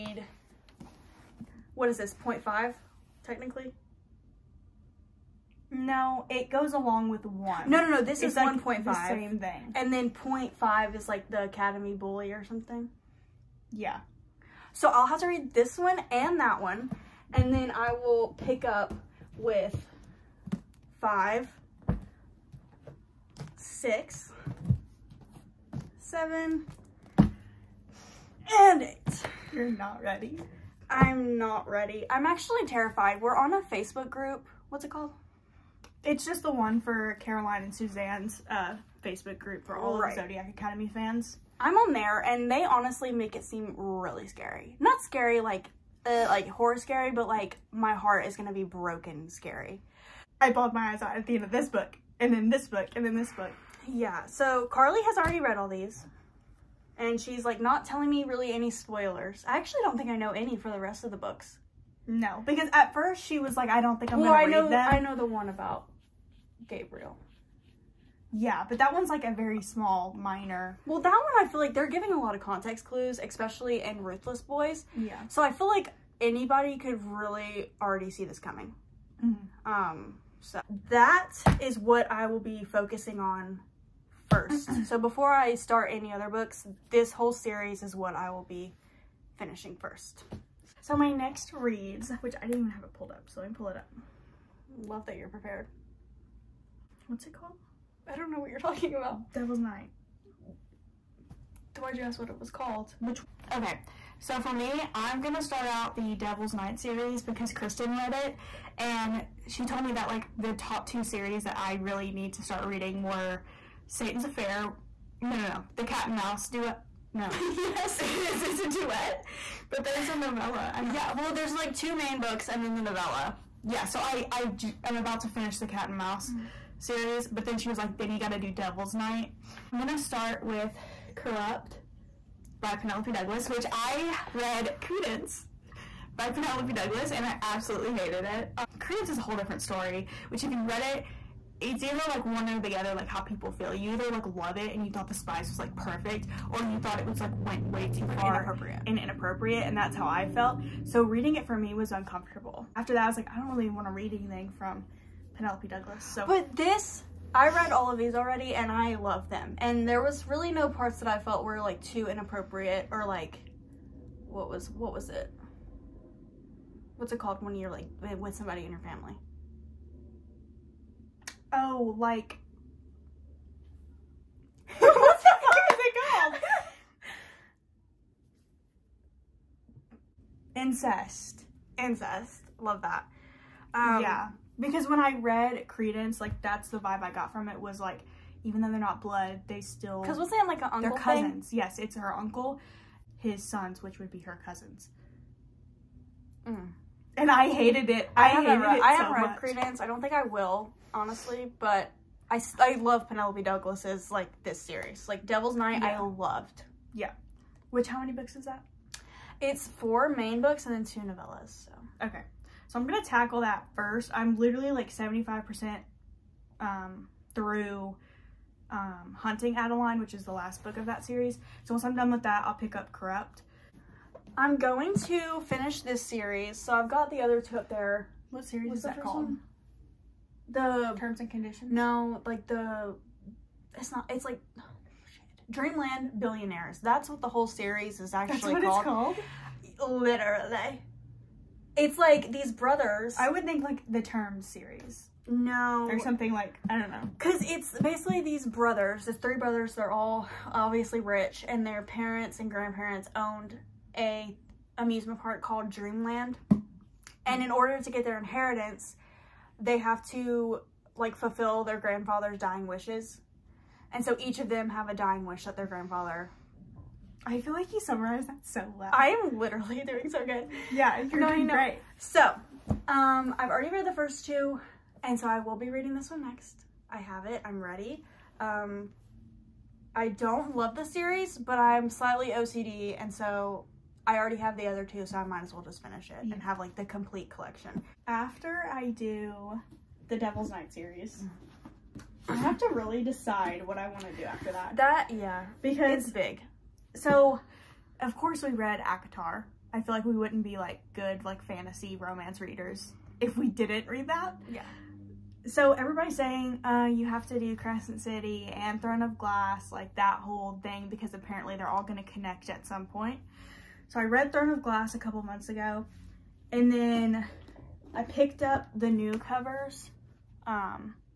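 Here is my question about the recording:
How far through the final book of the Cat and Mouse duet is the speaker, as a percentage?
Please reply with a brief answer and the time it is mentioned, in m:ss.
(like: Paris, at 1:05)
75%, at 3:34.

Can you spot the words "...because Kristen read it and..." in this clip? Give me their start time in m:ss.
1:47.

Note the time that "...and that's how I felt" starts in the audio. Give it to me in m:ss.
2:29.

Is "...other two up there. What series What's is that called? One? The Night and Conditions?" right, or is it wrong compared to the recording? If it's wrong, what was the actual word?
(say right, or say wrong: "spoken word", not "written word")
wrong: "Terms", not "Night".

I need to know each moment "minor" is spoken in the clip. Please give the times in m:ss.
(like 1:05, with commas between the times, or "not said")
1:10.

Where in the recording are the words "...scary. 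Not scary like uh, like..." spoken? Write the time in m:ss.
0:44.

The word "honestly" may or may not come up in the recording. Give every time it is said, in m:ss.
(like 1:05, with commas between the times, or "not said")
0:42, 3:20.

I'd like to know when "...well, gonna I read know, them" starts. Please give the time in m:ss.
1:04.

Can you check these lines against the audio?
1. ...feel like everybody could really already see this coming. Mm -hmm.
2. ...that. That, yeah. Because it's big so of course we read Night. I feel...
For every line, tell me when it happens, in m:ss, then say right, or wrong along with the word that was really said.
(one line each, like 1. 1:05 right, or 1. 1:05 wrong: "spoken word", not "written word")
1. 1:15 wrong: "anybody", not "everybody"
2. 4:54 wrong: "ACOTAR", not "Night".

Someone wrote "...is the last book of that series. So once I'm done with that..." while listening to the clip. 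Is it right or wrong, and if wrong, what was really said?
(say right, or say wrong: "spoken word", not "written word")
right.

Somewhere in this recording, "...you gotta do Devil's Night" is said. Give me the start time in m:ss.
2:08.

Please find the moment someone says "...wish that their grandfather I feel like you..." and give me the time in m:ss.
4:25.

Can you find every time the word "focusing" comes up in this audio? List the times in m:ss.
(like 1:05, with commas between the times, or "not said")
1:22.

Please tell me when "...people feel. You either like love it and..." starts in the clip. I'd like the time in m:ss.
2:23.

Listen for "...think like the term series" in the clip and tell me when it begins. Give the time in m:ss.
4:03.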